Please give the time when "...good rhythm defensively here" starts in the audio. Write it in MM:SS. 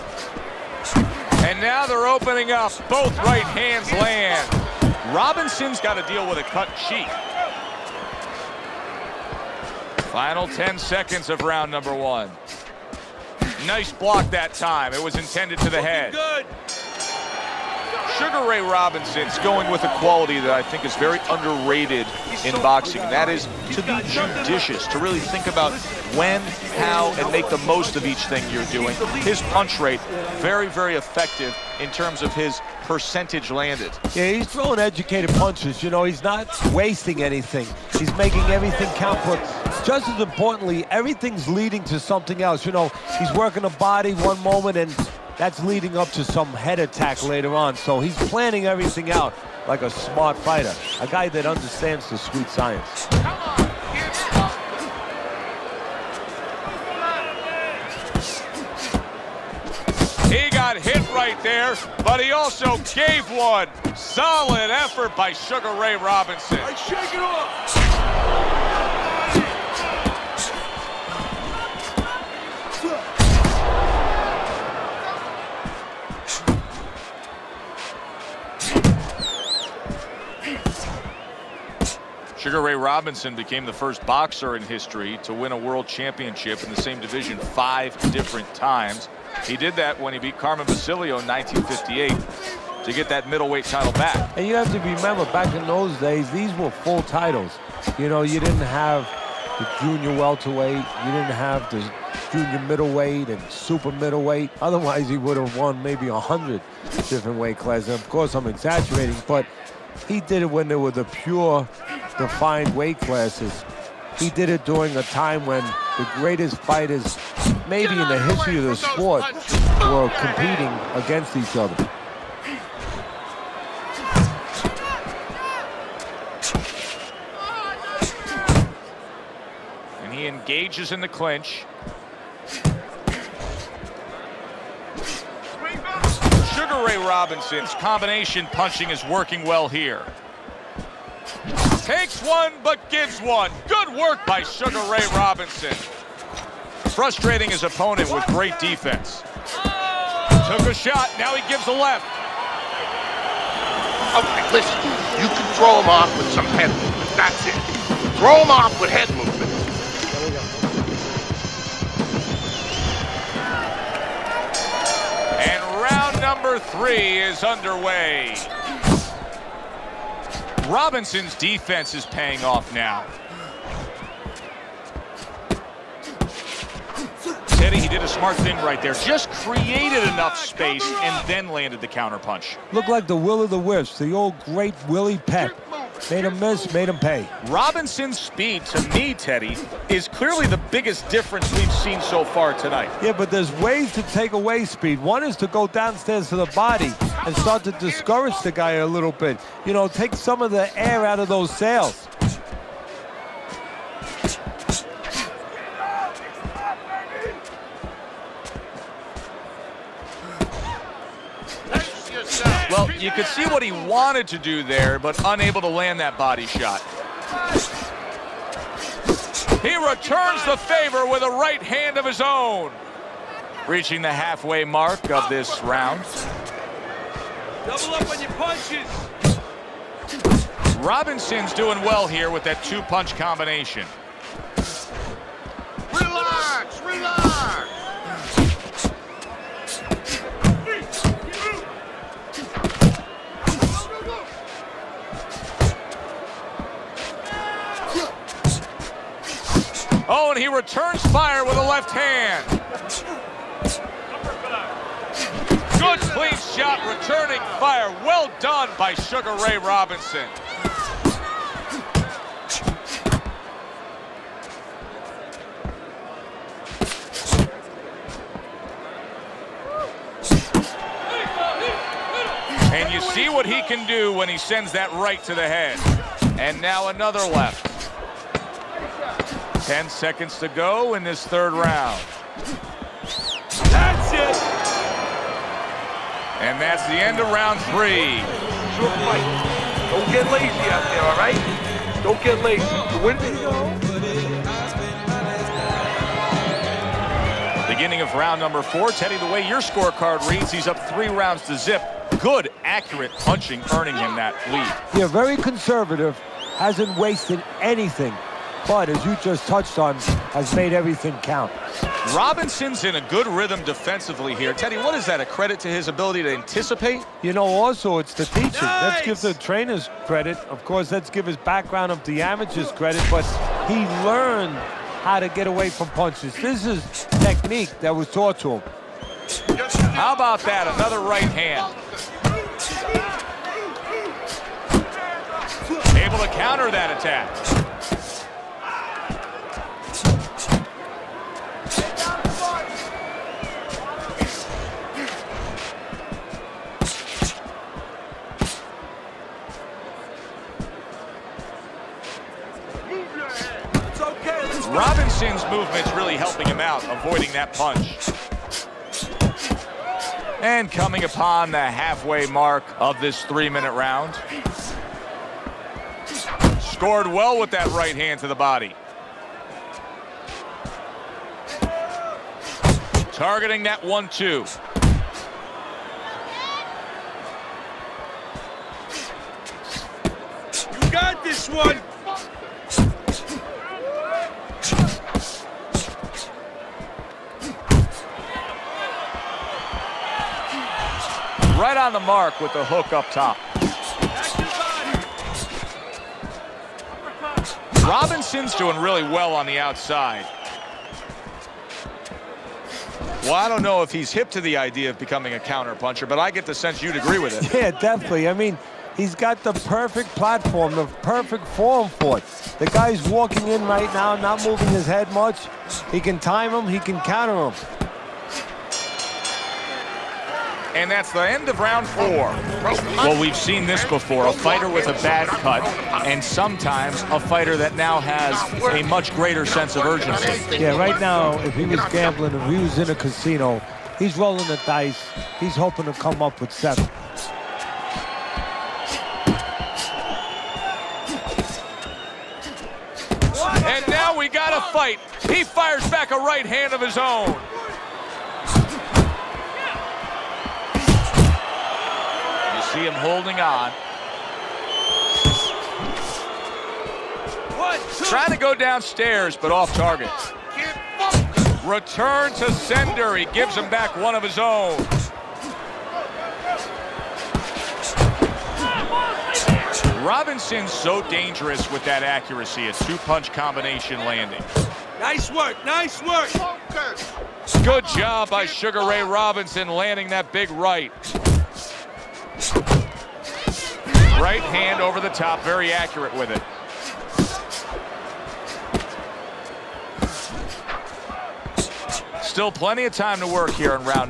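05:13.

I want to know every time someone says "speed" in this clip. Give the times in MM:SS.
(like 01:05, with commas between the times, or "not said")
03:08, 03:14.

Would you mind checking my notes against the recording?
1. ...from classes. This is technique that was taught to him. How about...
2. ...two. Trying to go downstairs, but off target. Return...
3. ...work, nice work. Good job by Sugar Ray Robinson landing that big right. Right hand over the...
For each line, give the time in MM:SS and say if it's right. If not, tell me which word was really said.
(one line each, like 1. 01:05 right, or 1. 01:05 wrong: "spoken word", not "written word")
1. 05:25 wrong: "punches", not "classes"
2. 07:37 right
3. 07:55 right.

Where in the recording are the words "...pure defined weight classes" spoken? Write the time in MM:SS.
01:51.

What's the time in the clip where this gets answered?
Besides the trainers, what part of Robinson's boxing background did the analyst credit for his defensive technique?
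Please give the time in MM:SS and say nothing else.
05:22.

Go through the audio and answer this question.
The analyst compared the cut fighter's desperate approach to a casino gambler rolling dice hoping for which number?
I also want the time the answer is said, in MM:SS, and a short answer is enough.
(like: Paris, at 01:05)
7, at 07:16.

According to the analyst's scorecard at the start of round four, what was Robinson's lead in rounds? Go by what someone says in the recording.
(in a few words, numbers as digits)
3 rounds to 0.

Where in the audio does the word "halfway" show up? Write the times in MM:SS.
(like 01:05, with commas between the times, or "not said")
03:44, 06:01.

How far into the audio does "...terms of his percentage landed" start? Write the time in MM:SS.
00:31.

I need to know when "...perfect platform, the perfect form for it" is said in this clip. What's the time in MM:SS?
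06:49.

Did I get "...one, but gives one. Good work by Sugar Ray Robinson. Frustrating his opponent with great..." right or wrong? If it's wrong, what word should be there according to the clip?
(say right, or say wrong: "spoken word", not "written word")
right.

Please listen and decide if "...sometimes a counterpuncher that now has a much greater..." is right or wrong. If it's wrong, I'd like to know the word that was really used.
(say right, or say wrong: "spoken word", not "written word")
wrong: "fighter", not "counterpuncher".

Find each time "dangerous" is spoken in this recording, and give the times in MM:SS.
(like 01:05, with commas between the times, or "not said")
07:51.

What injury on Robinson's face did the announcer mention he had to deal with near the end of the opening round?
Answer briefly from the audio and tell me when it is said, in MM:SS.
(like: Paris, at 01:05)
cut cheek, at 00:06.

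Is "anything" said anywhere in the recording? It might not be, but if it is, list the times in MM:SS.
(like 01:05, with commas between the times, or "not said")
00:37, 05:07.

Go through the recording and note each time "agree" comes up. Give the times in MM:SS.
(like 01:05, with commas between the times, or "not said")
06:46.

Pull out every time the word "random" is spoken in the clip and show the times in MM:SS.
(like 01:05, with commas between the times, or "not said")
not said.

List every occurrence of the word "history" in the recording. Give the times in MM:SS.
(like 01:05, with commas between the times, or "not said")
01:24, 01:58.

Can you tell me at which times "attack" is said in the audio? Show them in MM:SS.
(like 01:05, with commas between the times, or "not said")
00:46, 05:36.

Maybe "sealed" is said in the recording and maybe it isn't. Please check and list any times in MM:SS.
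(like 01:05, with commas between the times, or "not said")
not said.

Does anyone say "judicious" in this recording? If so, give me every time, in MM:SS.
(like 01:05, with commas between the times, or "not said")
00:24.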